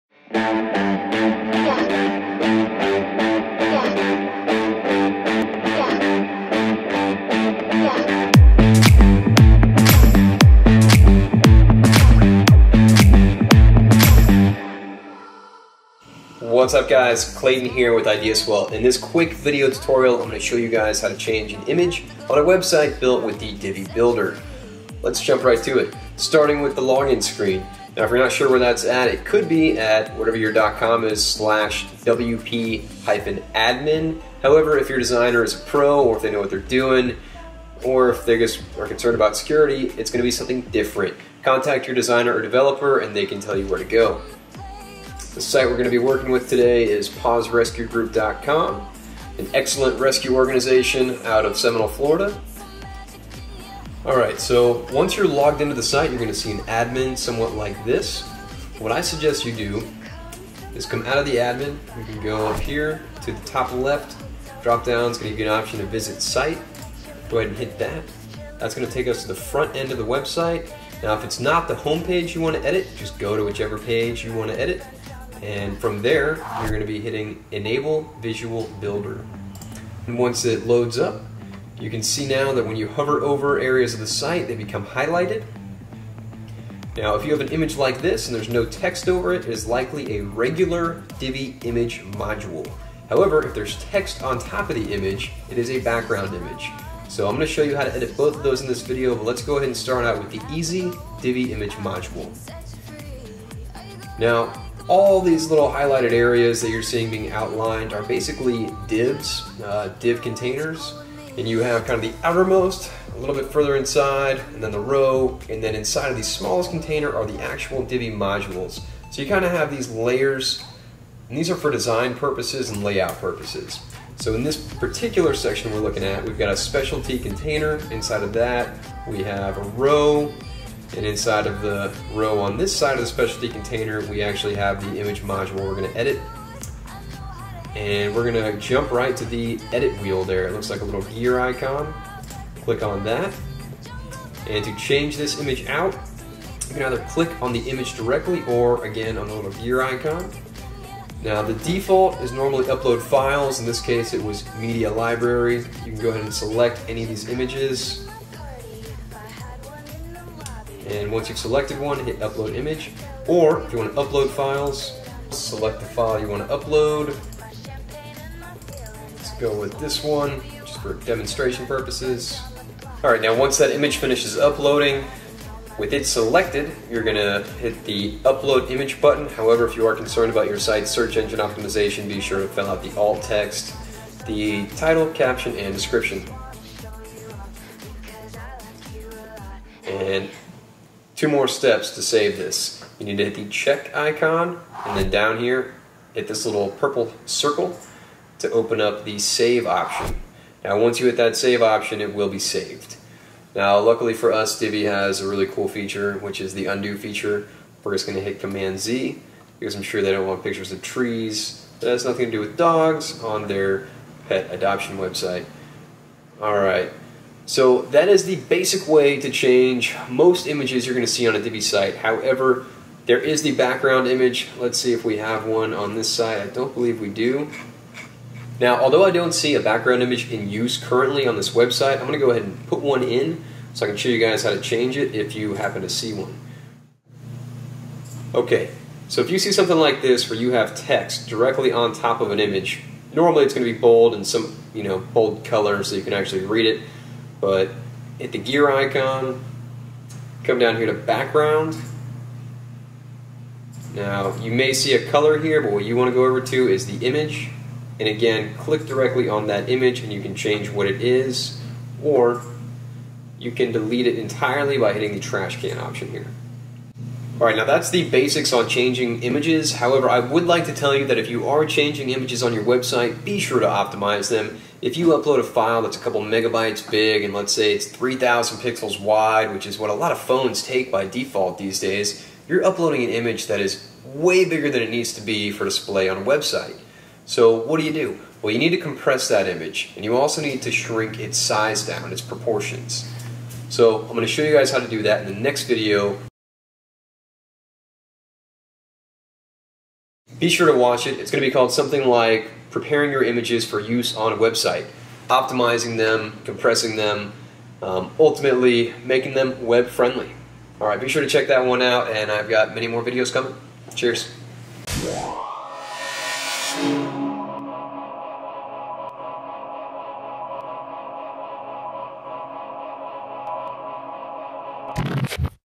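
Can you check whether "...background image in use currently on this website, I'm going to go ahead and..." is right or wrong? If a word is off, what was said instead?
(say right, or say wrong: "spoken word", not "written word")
right.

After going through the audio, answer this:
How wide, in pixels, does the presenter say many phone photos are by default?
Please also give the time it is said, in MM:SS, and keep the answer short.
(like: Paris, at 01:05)
3000, at 04:37.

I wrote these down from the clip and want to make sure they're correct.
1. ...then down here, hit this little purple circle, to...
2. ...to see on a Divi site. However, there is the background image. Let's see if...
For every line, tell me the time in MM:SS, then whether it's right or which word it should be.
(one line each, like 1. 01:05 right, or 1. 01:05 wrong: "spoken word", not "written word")
1. 03:14 right
2. 03:41 right.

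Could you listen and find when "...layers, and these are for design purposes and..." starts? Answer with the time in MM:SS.
01:59.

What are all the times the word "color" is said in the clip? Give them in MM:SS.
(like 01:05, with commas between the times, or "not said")
04:05, 04:15.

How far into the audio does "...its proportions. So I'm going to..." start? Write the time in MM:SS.
04:52.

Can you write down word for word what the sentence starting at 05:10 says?
All right, be sure to check that one out, and I've got many more videos coming.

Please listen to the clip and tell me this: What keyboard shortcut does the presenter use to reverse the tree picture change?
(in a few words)
Command Z.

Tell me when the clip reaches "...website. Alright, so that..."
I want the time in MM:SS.
03:34.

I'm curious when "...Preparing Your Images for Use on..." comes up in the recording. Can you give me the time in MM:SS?
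05:02.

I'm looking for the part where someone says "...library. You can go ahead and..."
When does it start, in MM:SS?
02:34.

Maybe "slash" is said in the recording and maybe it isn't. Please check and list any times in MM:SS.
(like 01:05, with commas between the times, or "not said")
00:31.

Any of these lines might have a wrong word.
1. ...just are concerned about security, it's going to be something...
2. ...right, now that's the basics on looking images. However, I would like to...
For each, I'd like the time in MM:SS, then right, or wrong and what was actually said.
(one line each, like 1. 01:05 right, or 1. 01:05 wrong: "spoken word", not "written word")
1. 00:38 right
2. 04:27 wrong: "changing", not "looking".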